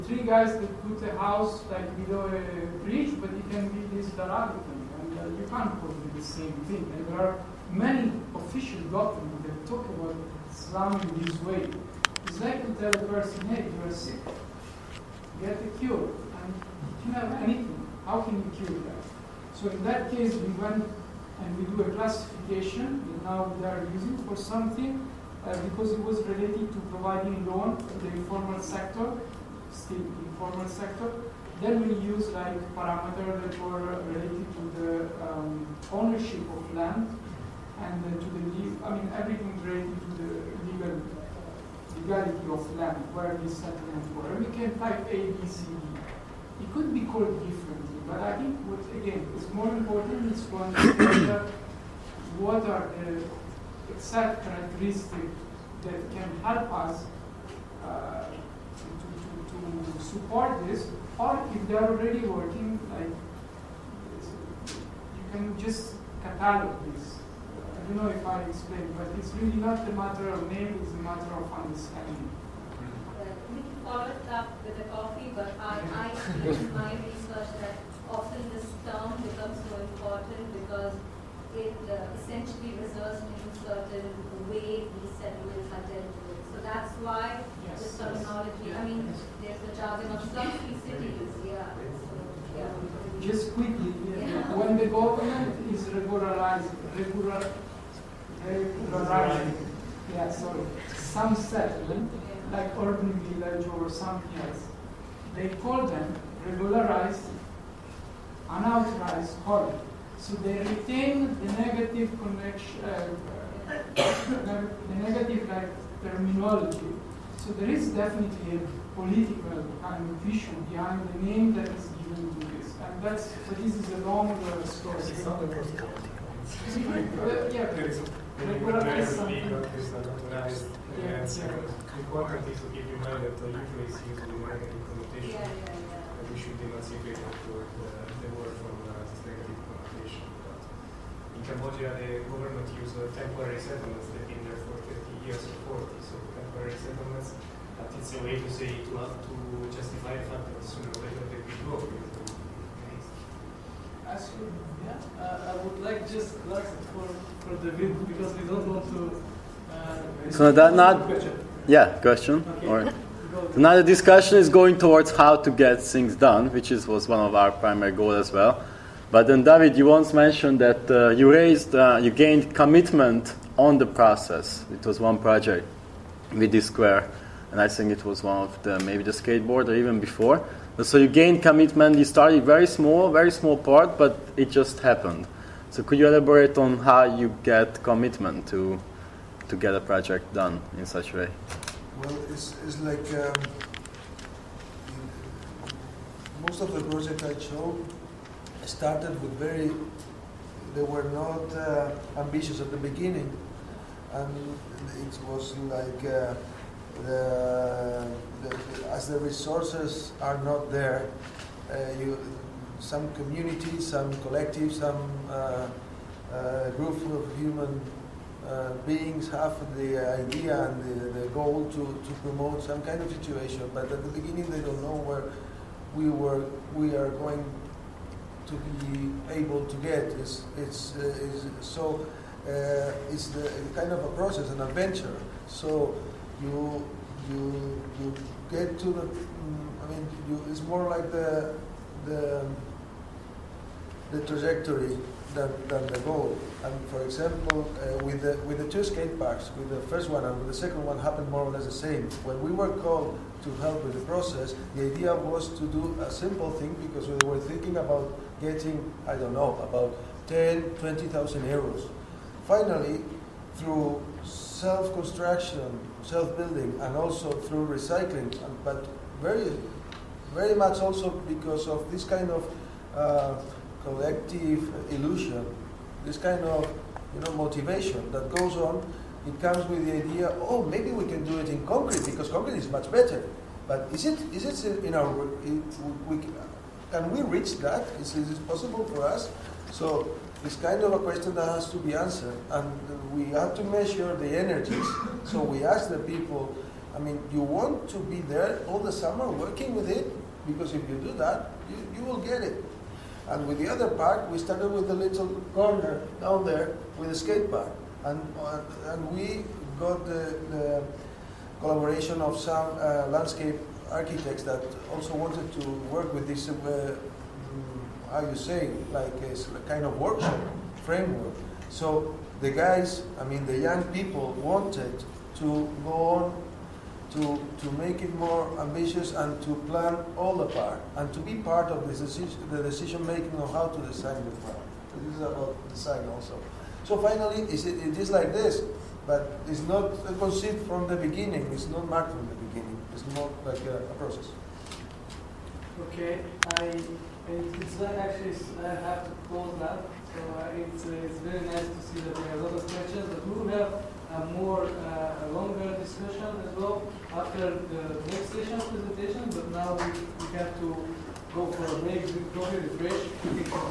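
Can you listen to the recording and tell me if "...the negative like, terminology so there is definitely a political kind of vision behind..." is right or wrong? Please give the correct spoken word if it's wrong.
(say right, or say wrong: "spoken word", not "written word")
right.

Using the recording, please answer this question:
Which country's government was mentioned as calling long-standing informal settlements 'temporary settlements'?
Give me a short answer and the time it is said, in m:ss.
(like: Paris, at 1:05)
Cambodia, at 2:21.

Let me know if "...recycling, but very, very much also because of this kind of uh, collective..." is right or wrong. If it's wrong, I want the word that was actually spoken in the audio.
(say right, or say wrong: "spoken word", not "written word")
right.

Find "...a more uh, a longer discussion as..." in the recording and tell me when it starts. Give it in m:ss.
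5:54.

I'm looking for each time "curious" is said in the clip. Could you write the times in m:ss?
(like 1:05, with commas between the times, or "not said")
not said.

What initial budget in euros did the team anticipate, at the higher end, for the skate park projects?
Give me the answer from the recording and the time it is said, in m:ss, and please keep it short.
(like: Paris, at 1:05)
20,000 euros, at 4:20.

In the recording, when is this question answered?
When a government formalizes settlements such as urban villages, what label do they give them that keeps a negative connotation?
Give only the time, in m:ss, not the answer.
1:46.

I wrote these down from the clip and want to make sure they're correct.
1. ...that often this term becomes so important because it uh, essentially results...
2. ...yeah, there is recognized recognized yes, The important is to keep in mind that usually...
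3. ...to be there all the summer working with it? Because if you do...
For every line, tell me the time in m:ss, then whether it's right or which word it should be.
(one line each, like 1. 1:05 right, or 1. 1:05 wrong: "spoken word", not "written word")
1. 1:17 right
2. 2:07 right
3. 4:57 right.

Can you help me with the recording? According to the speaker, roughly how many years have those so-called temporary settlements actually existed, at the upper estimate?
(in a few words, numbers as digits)
40.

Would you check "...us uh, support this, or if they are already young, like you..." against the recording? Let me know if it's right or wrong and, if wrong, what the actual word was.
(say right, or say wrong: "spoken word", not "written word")
wrong: "working", not "young".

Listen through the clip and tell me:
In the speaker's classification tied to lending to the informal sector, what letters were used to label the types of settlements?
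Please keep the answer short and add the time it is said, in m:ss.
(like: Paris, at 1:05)
A, B, C, D, at 0:45.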